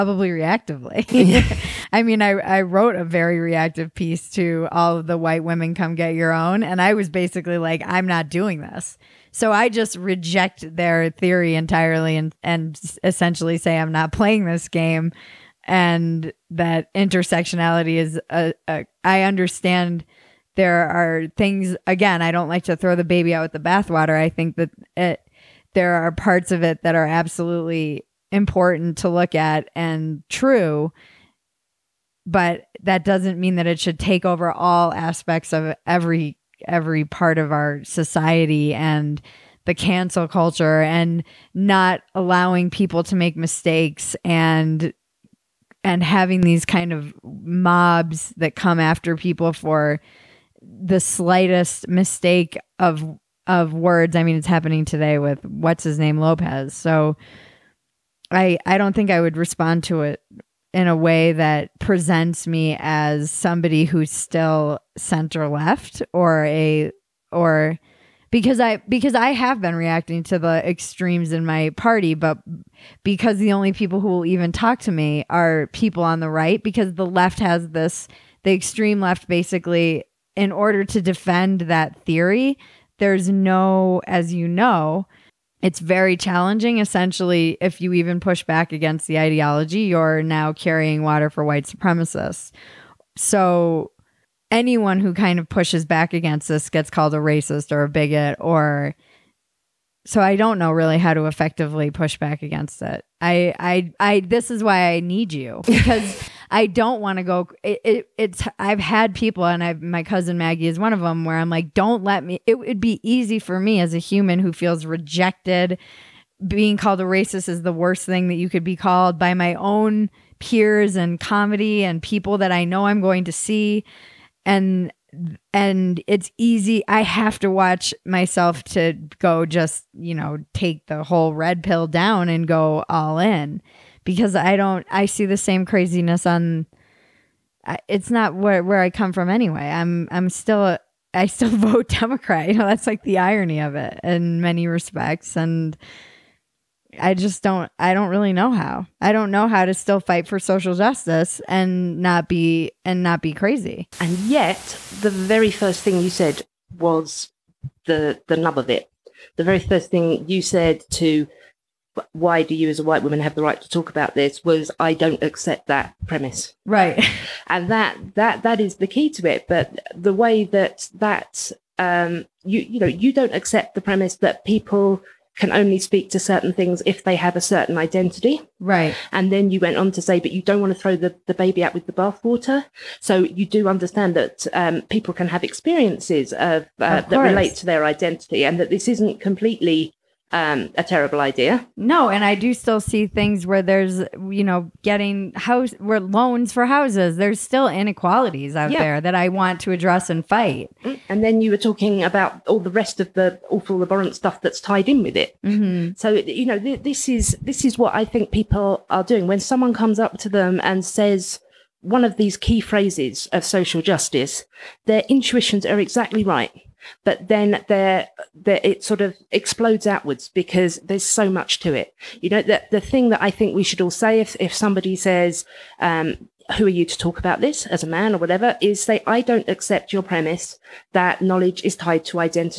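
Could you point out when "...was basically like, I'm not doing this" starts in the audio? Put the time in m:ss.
0:06.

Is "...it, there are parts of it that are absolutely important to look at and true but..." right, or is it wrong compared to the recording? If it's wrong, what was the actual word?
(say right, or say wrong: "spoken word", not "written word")
right.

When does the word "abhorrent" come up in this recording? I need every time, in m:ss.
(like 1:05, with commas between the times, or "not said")
3:23.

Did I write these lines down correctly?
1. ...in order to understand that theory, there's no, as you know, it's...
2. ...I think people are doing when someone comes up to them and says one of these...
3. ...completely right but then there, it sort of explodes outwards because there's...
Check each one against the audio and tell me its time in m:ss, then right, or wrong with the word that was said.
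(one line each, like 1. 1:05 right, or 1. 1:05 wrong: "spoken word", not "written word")
1. 1:20 wrong: "defend", not "understand"
2. 3:27 right
3. 3:35 wrong: "exactly", not "completely".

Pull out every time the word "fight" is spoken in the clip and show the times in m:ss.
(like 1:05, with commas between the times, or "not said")
2:29, 3:20.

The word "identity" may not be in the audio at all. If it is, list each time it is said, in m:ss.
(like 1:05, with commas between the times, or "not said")
2:57, 3:07.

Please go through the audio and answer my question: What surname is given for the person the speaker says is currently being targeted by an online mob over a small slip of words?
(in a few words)
Lopez.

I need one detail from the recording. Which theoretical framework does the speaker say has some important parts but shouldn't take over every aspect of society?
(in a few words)
intersectionality.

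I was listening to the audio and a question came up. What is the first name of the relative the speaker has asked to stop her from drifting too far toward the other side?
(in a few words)
Maggie.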